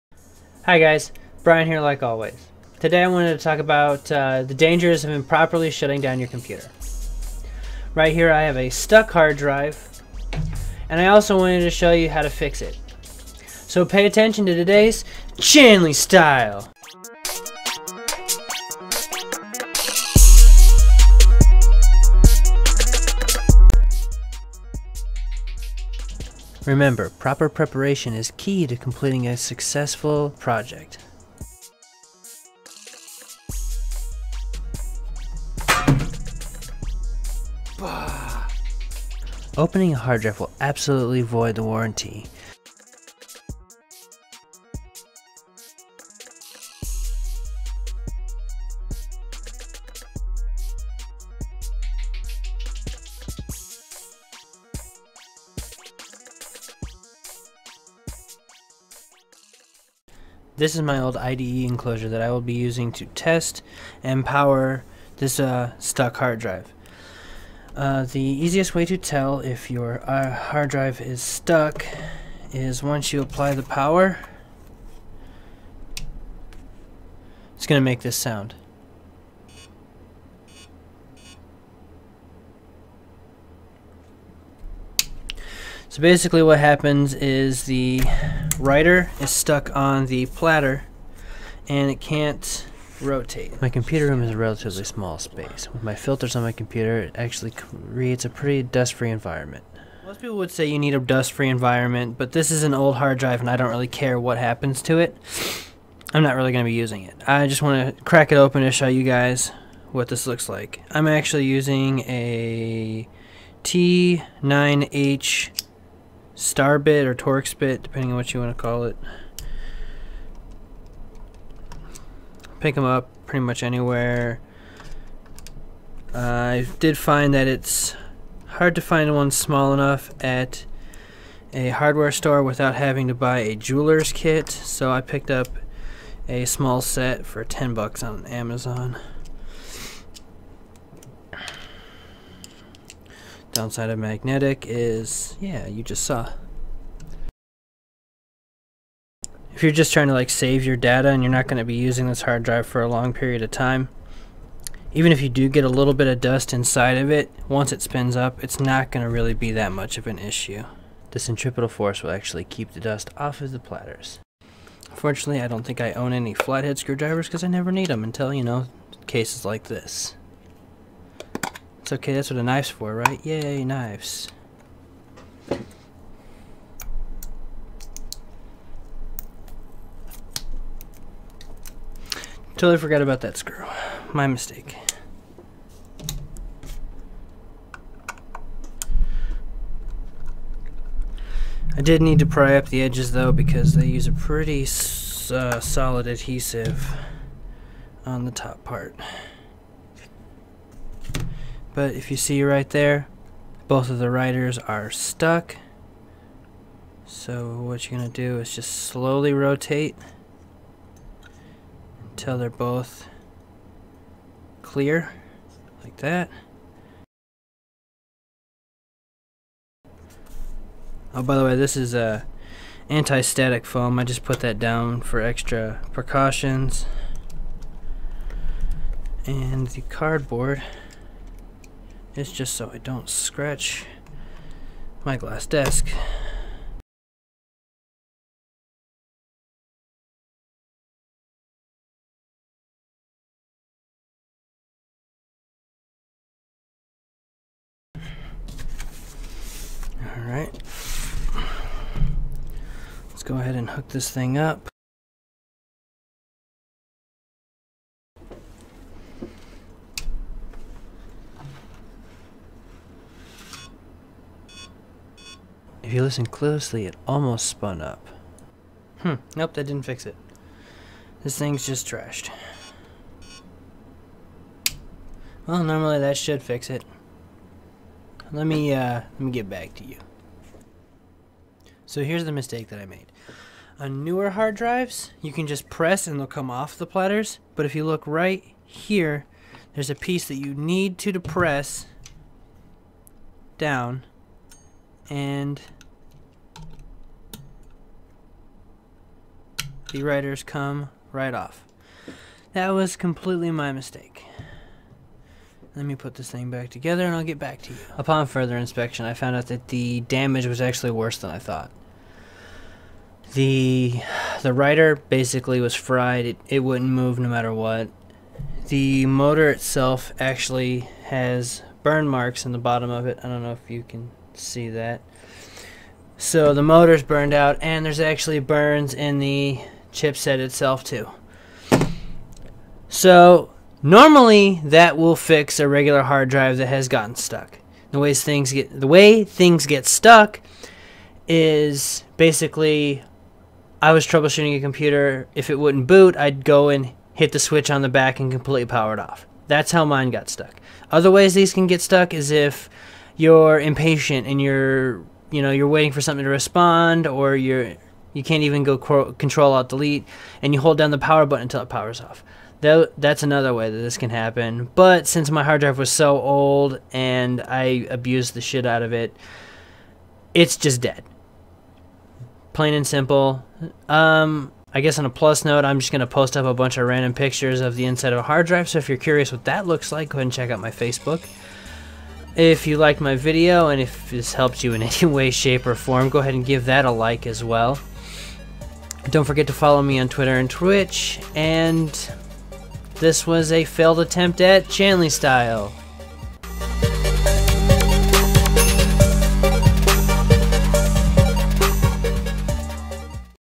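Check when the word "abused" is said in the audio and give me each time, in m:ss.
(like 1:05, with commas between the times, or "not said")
6:07.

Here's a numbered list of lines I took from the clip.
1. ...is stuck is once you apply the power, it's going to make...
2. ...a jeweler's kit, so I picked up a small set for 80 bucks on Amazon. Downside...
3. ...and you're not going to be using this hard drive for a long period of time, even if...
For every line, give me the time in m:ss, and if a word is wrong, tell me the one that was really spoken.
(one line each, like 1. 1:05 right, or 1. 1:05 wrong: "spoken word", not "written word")
1. 1:11 right
2. 2:13 wrong: "10", not "80"
3. 2:31 right.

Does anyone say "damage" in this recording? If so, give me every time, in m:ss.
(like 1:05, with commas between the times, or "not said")
5:10.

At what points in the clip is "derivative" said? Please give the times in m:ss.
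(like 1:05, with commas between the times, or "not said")
not said.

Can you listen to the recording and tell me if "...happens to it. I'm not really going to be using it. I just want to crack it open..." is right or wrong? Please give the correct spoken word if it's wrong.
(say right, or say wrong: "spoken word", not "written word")
right.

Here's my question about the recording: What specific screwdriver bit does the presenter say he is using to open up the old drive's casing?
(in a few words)
T9H star bit.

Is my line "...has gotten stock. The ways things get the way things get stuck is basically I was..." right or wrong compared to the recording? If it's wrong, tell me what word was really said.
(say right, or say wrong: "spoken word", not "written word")
wrong: "stuck", not "stock".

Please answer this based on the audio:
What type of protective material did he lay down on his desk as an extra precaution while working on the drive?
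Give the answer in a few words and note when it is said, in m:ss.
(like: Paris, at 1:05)
Anti-static foam, at 3:42.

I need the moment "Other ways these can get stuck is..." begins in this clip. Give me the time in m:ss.
5:50.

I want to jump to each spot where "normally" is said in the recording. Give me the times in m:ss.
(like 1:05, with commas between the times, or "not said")
4:35, 5:33.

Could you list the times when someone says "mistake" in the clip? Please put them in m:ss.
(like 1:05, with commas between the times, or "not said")
3:04, 4:42, 5:03.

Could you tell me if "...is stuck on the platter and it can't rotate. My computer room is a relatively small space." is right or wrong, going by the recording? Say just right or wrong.
right.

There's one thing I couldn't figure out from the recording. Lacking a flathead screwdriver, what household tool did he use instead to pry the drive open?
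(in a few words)
A knife.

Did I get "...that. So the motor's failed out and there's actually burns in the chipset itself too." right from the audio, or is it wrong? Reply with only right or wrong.
wrong.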